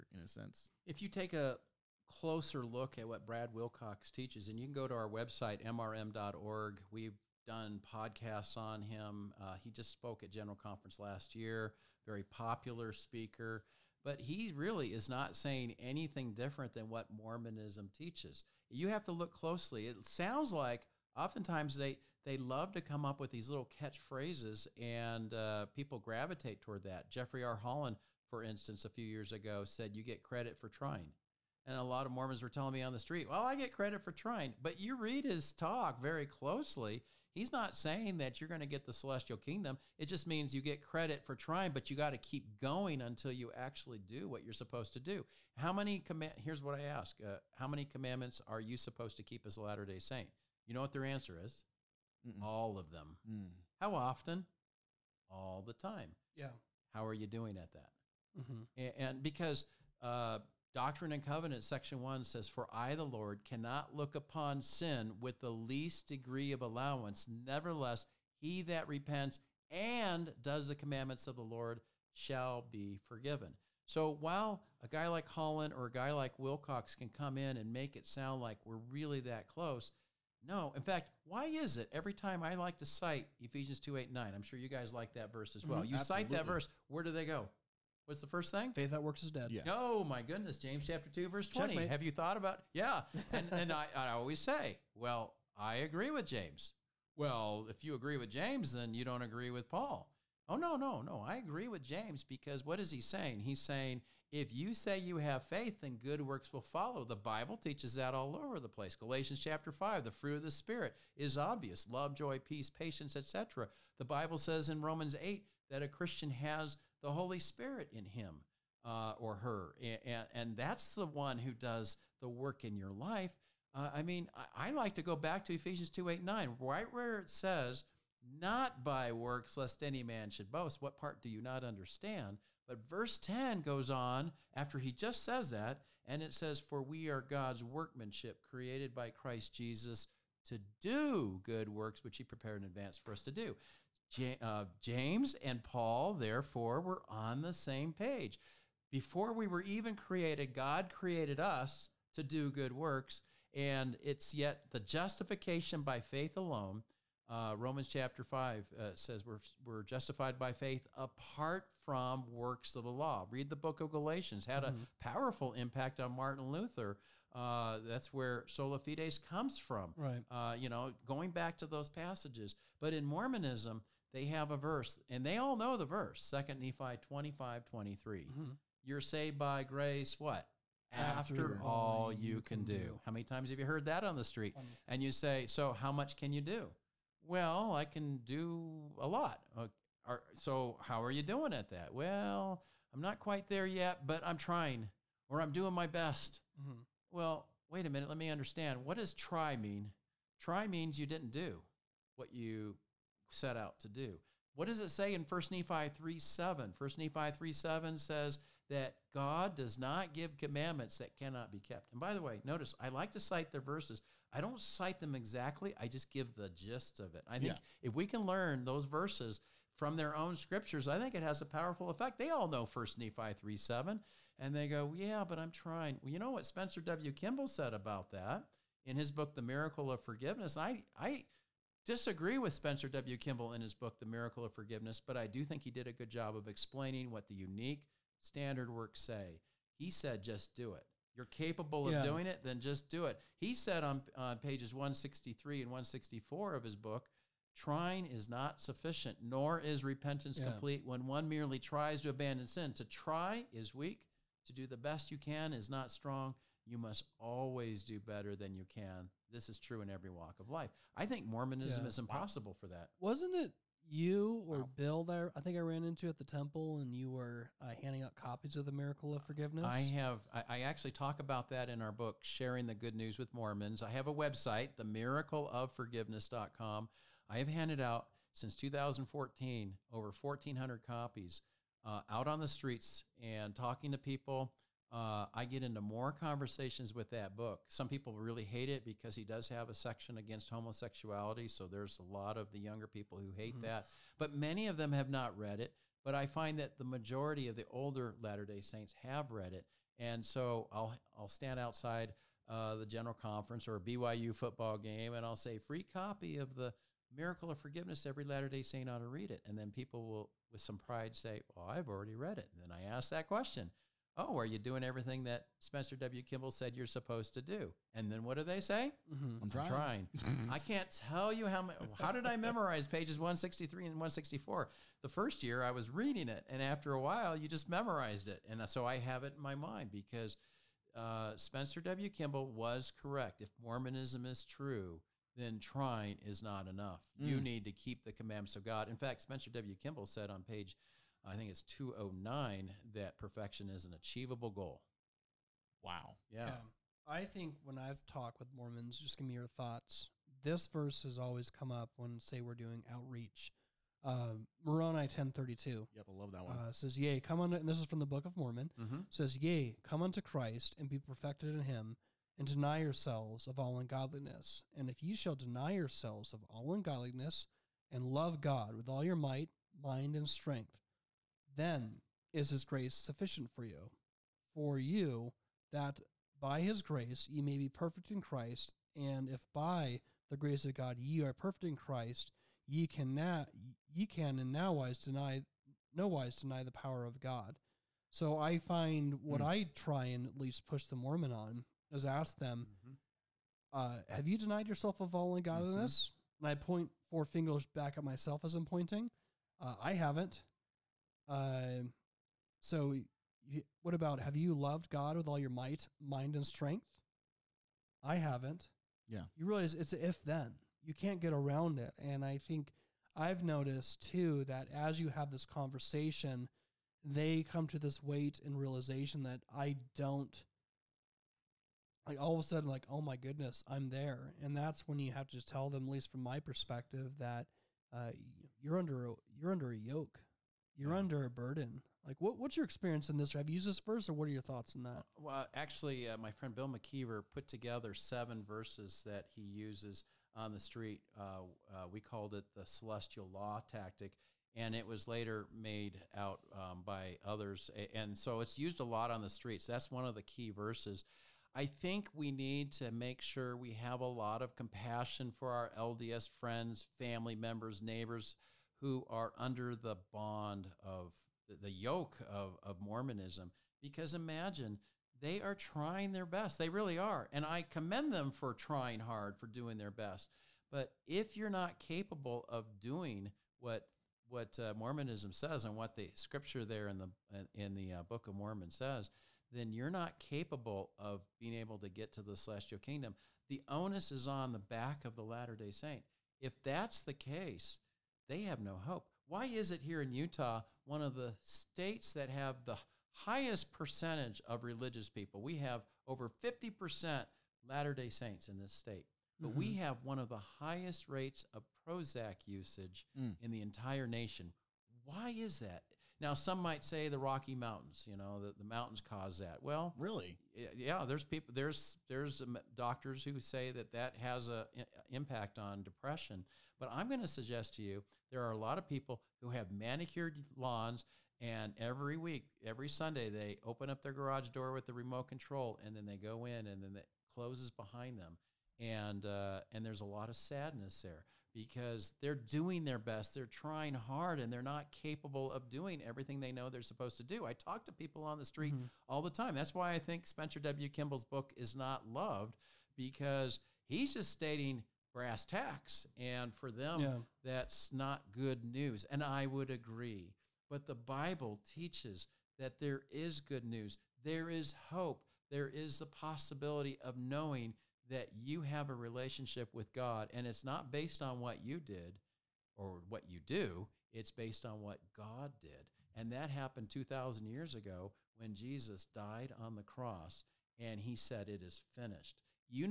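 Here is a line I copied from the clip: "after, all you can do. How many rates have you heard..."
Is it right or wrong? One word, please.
wrong.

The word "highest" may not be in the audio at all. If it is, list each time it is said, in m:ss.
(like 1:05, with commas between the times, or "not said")
8:13, 8:20.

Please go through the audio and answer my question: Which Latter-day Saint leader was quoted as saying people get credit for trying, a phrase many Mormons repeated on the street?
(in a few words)
Jeffrey R. Holland.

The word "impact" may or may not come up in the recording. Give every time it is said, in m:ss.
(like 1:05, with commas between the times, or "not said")
2:45, 8:35.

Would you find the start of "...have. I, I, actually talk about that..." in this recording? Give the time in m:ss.
4:29.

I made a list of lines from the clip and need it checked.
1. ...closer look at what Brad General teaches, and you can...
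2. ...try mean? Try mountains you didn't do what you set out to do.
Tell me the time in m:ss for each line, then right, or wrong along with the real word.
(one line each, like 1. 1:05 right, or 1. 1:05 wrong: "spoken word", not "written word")
1. 0:02 wrong: "Wilcox", not "General"
2. 3:19 wrong: "means", not "mountains".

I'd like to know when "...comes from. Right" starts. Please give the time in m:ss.
2:49.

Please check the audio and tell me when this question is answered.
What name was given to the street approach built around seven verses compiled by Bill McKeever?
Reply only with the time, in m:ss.
7:22.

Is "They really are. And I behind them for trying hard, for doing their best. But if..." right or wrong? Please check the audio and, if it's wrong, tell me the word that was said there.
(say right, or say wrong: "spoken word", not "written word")
wrong: "commend", not "behind".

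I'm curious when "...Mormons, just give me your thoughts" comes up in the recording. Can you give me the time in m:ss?
5:48.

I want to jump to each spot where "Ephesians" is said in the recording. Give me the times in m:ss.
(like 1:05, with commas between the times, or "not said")
1:23, 2:05.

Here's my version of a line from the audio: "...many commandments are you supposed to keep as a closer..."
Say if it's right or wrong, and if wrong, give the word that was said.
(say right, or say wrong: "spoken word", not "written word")
wrong: "latter", not "closer".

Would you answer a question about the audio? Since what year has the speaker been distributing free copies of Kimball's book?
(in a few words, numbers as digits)
2014.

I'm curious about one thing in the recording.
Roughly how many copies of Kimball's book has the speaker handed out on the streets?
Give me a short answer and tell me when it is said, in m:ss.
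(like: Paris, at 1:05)
over 1,400, at 4:39.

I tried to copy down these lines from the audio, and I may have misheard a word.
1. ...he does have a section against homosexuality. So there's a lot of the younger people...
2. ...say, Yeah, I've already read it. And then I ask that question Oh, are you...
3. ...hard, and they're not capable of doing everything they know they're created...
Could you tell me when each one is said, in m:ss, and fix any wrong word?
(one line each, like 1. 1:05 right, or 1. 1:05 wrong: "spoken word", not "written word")
1. 4:49 right
2. 5:11 wrong: "Well", not "Yeah"
3. 8:53 wrong: "supposed", not "created".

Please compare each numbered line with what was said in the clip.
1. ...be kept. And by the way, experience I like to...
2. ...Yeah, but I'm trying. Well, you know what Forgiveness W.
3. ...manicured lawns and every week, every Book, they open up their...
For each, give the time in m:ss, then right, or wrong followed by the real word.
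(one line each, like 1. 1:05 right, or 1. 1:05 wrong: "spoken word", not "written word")
1. 3:31 wrong: "notice", not "experience"
2. 3:44 wrong: "Spencer", not "Forgiveness"
3. 8:39 wrong: "Sunday", not "Book".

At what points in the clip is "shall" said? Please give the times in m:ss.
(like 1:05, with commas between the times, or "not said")
1:12, 6:05.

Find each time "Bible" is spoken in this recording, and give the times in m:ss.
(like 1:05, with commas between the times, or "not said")
1:47, 1:54, 9:10.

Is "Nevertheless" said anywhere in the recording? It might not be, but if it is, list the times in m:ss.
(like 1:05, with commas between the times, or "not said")
1:07.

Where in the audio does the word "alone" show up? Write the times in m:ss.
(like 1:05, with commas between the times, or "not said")
2:36.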